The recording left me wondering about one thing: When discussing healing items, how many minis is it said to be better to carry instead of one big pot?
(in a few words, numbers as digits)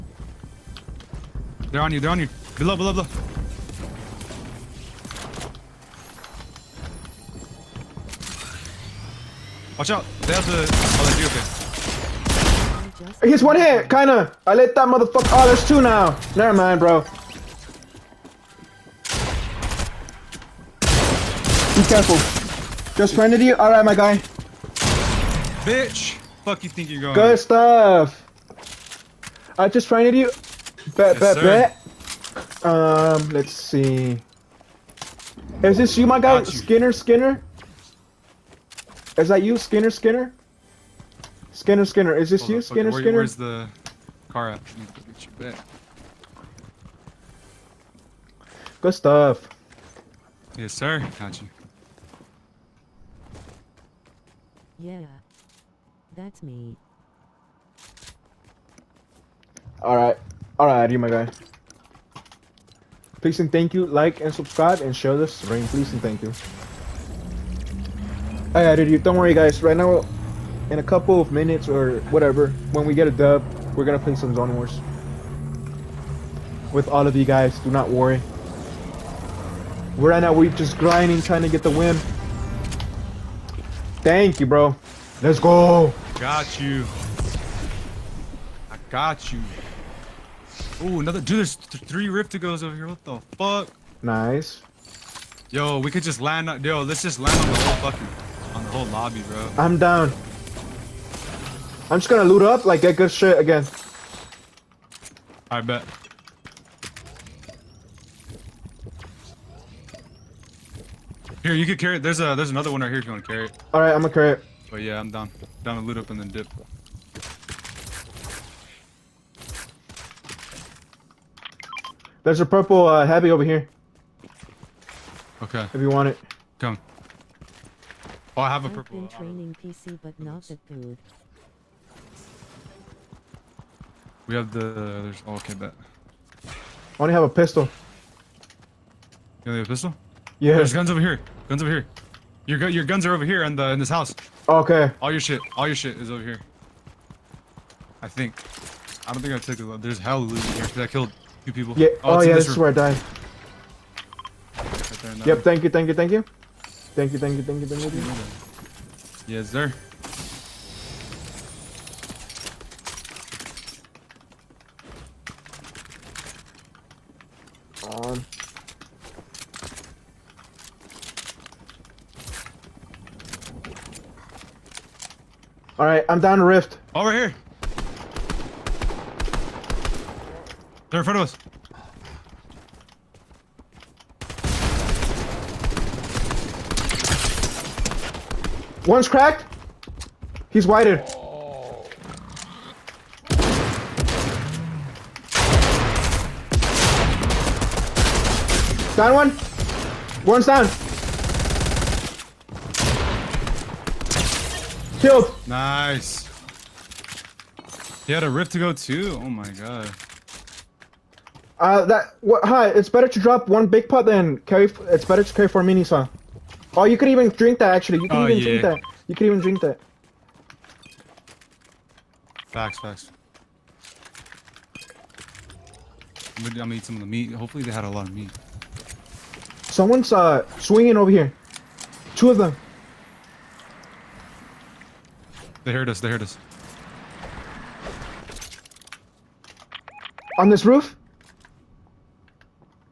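4.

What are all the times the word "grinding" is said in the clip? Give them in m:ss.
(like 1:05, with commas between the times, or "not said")
1:20.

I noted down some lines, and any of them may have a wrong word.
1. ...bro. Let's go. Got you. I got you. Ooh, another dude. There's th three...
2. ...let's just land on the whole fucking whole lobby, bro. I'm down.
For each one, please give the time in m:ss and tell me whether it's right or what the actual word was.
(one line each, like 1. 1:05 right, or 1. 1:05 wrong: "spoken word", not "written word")
1. 1:24 right
2. 1:36 right.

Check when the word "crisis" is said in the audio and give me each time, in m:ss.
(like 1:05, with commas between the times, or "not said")
not said.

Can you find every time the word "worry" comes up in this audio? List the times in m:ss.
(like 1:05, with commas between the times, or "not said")
1:09, 1:17.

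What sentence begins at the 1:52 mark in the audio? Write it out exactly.
There's a there's another one right here if you want to carry it.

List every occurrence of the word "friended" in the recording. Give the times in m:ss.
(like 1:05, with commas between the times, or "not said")
0:23, 0:29.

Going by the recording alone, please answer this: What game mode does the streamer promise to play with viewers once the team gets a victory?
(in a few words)
Zone Wars.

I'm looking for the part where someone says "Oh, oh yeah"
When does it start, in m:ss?
2:32.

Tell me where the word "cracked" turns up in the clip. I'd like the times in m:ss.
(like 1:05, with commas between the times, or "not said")
3:09.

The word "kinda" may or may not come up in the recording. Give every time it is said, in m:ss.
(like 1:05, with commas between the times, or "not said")
0:13.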